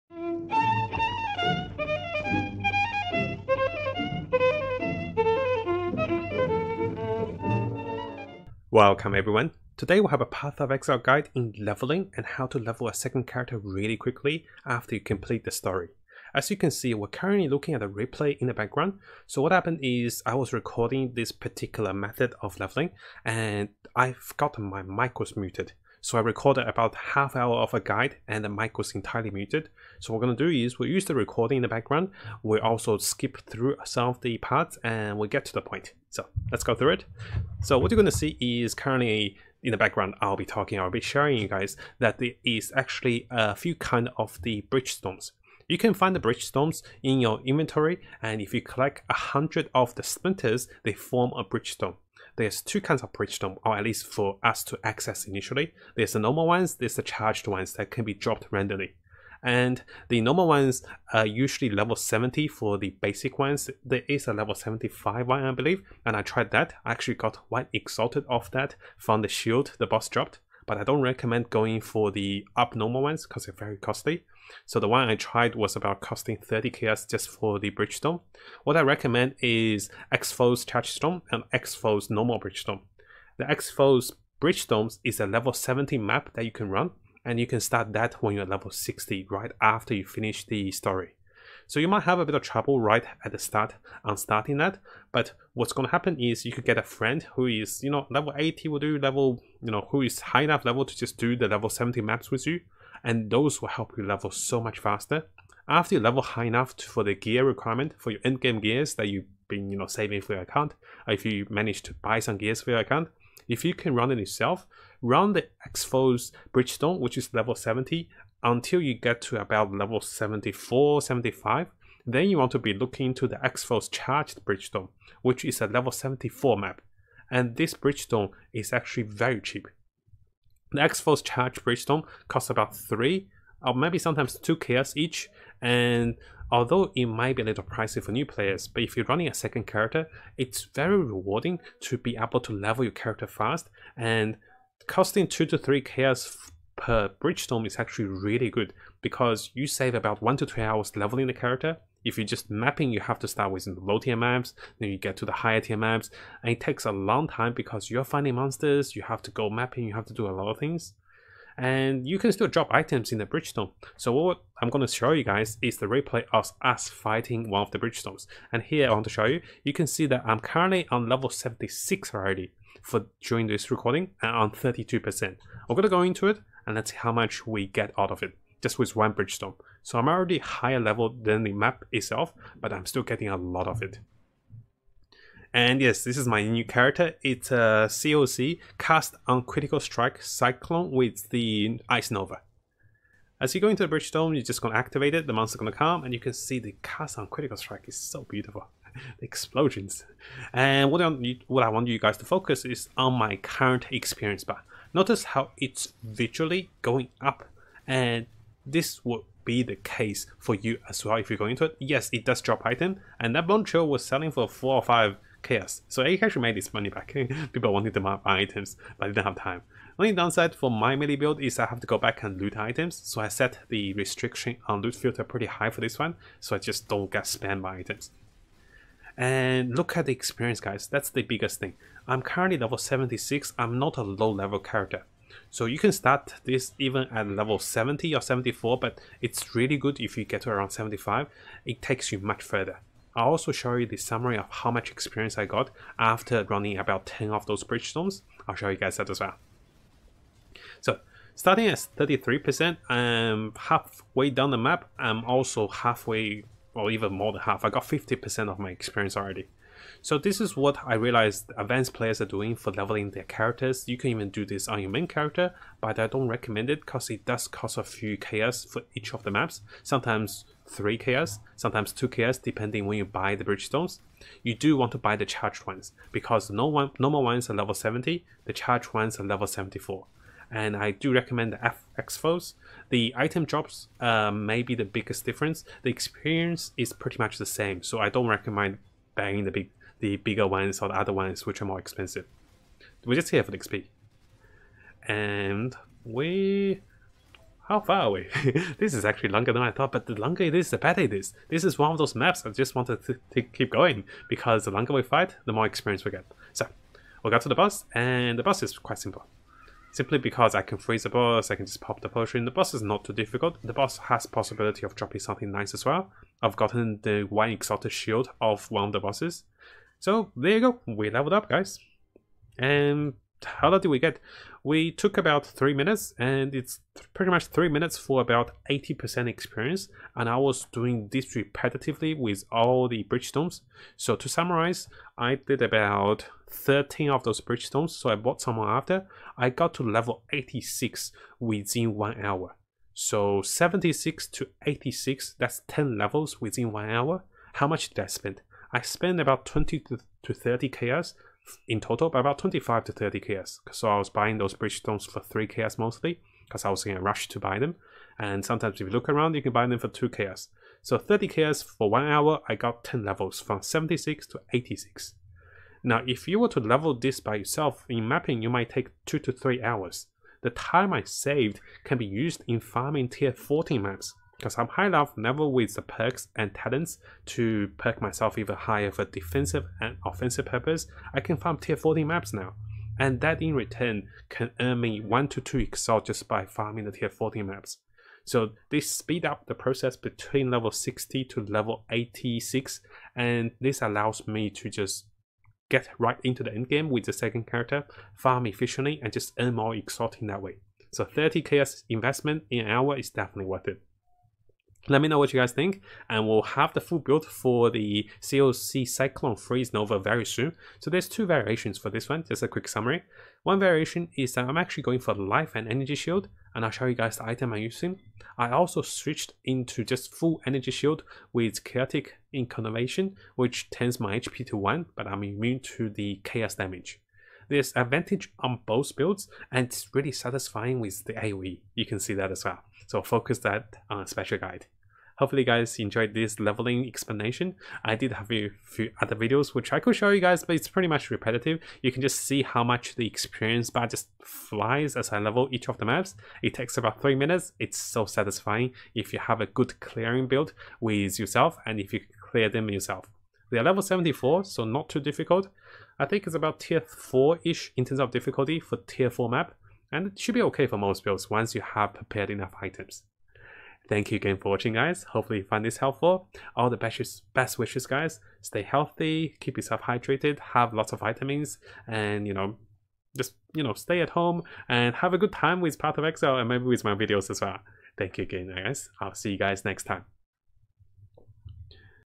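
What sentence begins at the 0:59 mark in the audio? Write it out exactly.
And the normal ones are usually level 70 for the basic ones.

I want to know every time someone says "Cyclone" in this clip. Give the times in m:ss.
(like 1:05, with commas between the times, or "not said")
3:10, 6:48.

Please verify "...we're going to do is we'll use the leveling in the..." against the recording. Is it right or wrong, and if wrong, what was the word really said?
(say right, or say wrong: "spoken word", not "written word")
wrong: "recording", not "leveling".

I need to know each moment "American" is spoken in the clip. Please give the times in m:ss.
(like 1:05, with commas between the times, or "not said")
not said.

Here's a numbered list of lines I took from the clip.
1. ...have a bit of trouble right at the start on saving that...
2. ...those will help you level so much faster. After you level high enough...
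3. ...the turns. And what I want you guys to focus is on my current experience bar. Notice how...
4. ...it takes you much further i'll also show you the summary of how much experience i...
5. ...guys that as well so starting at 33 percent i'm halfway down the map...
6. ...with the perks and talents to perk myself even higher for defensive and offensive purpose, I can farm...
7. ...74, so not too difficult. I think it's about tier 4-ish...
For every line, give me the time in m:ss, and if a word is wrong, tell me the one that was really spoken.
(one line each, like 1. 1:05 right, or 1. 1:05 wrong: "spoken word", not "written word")
1. 1:32 wrong: "starting", not "saving"
2. 1:43 right
3. 3:19 wrong: "explosions", not "turns"
4. 4:01 right
5. 4:08 right
6. 6:15 right
7. 7:33 right.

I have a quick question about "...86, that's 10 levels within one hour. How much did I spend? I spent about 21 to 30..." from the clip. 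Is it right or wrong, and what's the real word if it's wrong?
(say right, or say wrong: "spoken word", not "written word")
wrong: "20", not "21".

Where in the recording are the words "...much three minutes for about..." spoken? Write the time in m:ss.
5:27.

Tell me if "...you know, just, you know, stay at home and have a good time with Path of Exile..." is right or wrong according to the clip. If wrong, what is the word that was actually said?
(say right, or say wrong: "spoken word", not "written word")
right.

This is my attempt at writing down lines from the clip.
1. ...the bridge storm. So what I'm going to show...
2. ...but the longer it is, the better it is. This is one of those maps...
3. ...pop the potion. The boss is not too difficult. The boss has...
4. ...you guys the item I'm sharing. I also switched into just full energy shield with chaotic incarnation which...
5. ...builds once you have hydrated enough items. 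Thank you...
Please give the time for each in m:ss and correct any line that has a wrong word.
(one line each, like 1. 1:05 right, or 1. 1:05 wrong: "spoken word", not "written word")
1. 2:43 right
2. 4:59 right
3. 5:11 right
4. 6:56 wrong: "using", not "sharing"
5. 7:41 wrong: "prepared", not "hydrated".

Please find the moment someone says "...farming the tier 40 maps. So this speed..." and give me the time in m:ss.
6:26.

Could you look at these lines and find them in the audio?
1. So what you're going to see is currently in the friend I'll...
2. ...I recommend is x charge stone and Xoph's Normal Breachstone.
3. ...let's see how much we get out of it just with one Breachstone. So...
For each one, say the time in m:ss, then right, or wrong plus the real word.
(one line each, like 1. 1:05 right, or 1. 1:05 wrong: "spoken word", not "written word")
1. 0:37 wrong: "background", not "friend"
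2. 1:18 right
3. 2:56 right.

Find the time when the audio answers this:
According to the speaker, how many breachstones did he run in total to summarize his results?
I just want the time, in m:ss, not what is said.
5:36.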